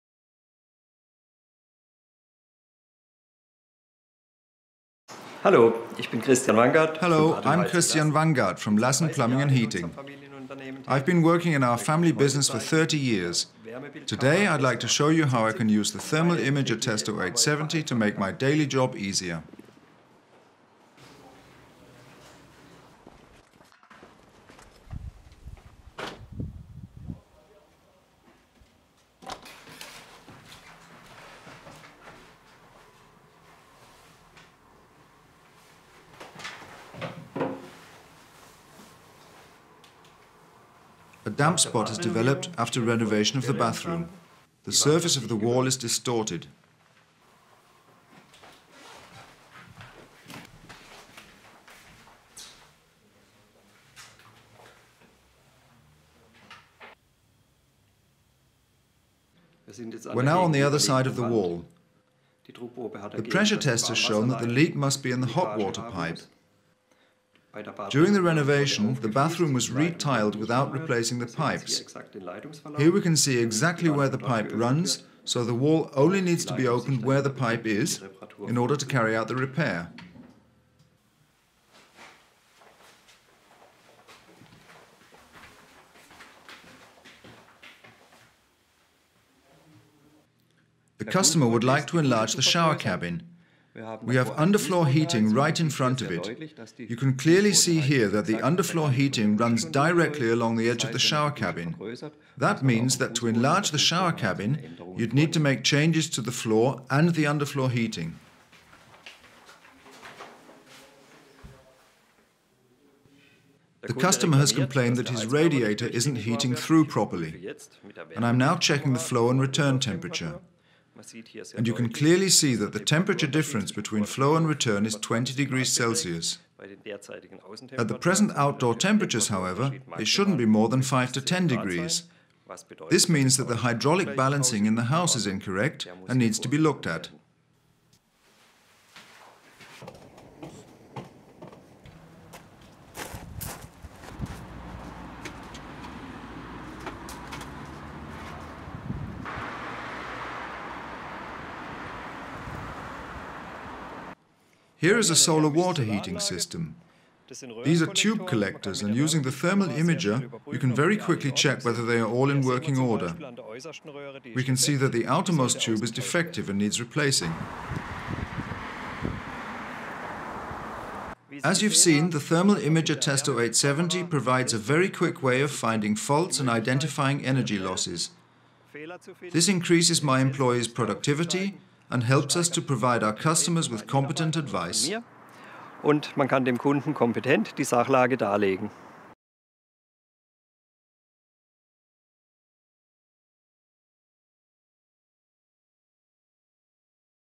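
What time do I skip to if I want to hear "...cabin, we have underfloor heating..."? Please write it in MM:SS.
01:32.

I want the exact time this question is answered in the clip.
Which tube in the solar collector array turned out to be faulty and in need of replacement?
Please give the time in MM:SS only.
02:45.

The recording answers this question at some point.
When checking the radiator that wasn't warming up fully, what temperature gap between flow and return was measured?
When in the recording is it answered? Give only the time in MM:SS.
02:04.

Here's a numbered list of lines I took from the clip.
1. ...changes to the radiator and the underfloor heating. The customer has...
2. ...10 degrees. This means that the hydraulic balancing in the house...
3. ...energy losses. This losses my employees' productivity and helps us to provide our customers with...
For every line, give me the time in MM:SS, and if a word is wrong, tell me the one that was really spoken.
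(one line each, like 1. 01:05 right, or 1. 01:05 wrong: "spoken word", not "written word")
1. 01:45 wrong: "floor", not "radiator"
2. 02:11 right
3. 02:57 wrong: "increases", not "losses".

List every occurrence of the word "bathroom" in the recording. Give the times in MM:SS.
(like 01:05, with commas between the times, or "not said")
00:43, 01:09.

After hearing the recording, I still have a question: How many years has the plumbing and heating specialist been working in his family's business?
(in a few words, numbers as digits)
30.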